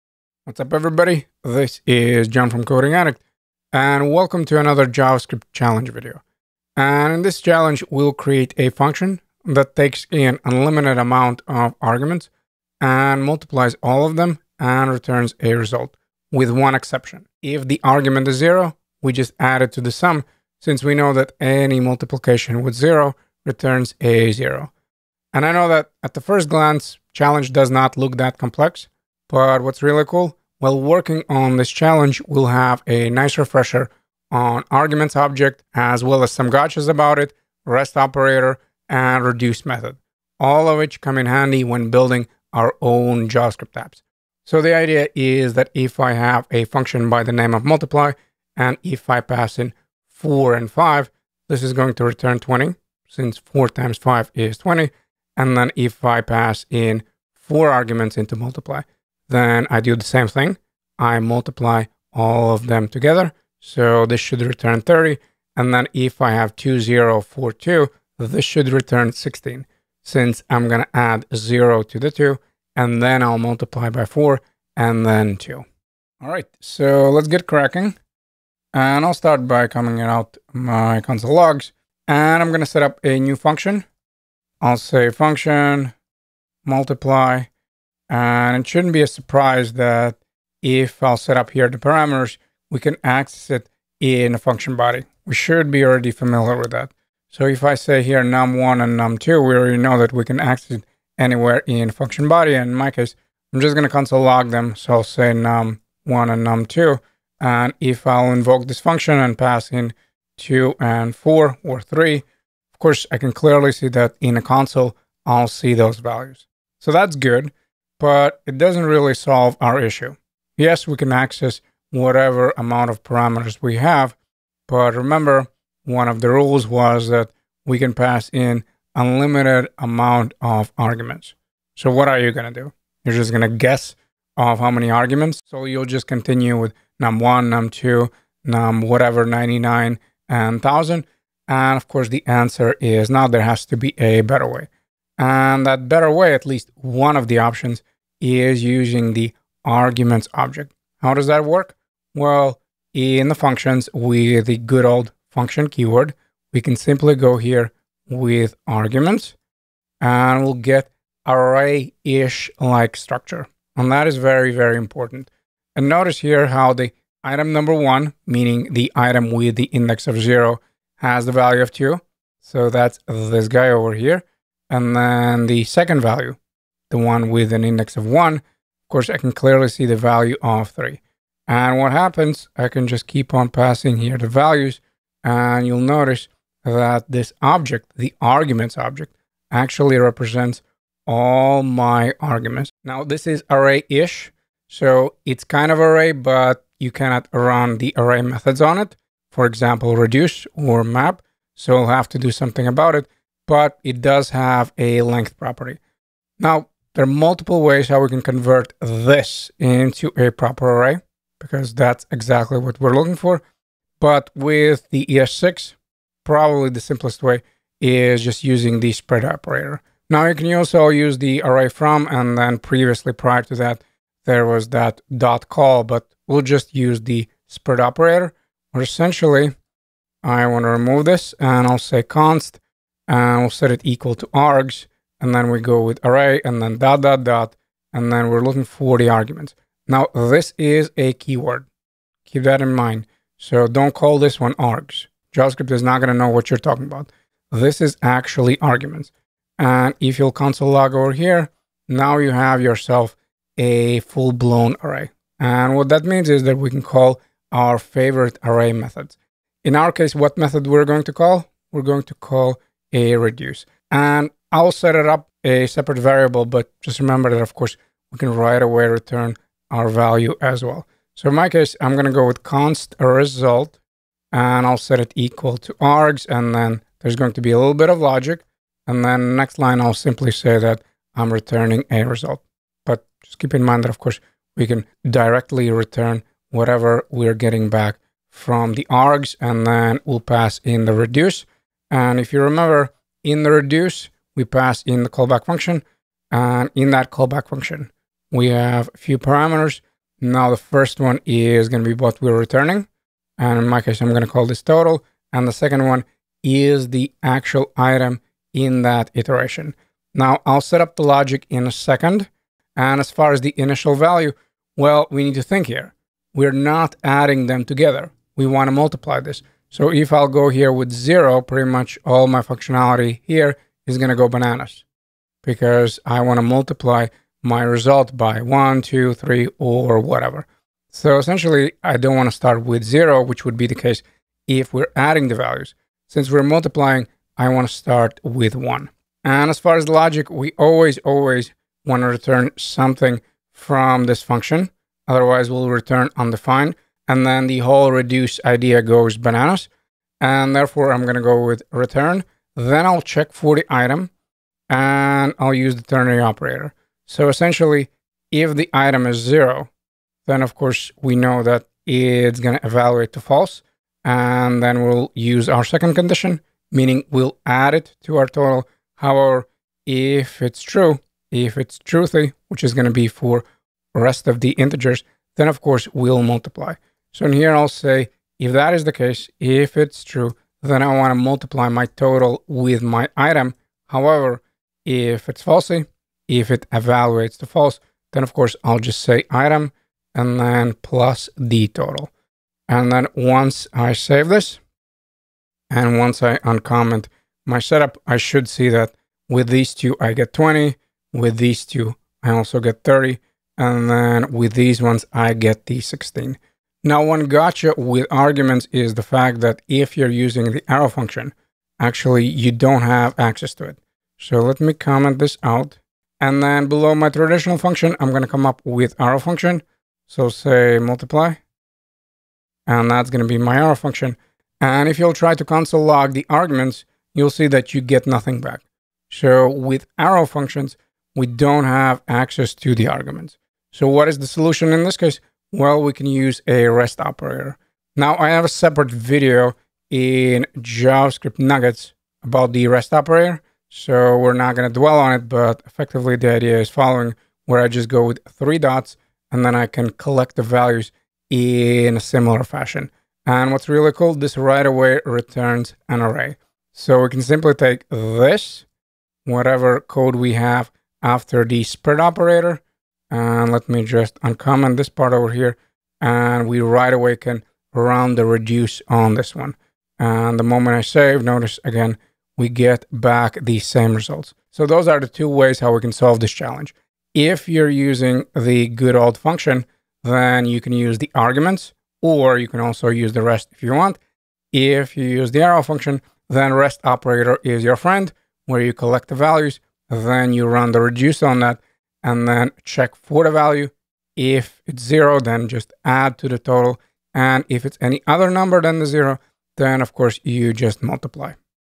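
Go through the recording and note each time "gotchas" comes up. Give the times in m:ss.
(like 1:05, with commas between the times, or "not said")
0:36, 6:47.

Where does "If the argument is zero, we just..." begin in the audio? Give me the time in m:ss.
0:17.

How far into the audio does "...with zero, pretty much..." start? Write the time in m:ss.
5:20.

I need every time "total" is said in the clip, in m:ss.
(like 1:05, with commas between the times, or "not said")
5:04, 6:08, 6:21, 6:31, 8:16.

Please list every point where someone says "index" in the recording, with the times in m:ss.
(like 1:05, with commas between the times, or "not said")
2:49, 2:57.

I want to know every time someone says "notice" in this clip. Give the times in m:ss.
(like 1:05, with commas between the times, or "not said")
2:45, 3:05, 7:51.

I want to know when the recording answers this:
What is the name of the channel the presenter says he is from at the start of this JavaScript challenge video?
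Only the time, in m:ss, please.
0:02.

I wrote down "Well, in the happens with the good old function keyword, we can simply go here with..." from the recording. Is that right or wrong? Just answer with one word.
wrong.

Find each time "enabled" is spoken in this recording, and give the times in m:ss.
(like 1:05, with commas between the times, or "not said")
not said.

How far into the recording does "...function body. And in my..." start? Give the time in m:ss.
1:41.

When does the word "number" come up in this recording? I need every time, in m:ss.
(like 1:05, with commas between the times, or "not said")
2:47, 8:18.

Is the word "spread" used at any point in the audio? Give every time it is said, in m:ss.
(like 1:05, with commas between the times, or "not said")
3:38, 3:47, 7:41.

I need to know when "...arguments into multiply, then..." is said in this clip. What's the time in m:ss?
0:57.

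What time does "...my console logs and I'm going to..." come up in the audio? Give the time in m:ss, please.
1:20.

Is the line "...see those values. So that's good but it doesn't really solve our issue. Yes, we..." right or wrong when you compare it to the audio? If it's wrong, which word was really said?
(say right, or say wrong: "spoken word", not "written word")
right.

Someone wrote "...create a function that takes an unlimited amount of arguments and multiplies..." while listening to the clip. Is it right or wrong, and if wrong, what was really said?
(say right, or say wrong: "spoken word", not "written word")
right.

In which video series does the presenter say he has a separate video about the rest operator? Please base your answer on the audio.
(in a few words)
JavaScript nuggets.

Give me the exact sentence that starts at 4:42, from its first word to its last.
But just keep in mind that, of course, we can directly return whatever we're getting back from the args.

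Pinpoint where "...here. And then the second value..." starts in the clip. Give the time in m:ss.
2:53.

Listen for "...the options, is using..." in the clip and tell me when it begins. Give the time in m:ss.
2:27.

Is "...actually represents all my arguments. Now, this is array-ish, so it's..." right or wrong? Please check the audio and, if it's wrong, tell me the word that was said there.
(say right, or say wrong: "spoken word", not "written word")
right.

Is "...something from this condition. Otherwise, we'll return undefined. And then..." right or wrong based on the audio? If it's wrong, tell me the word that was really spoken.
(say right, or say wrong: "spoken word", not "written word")
wrong: "function", not "condition".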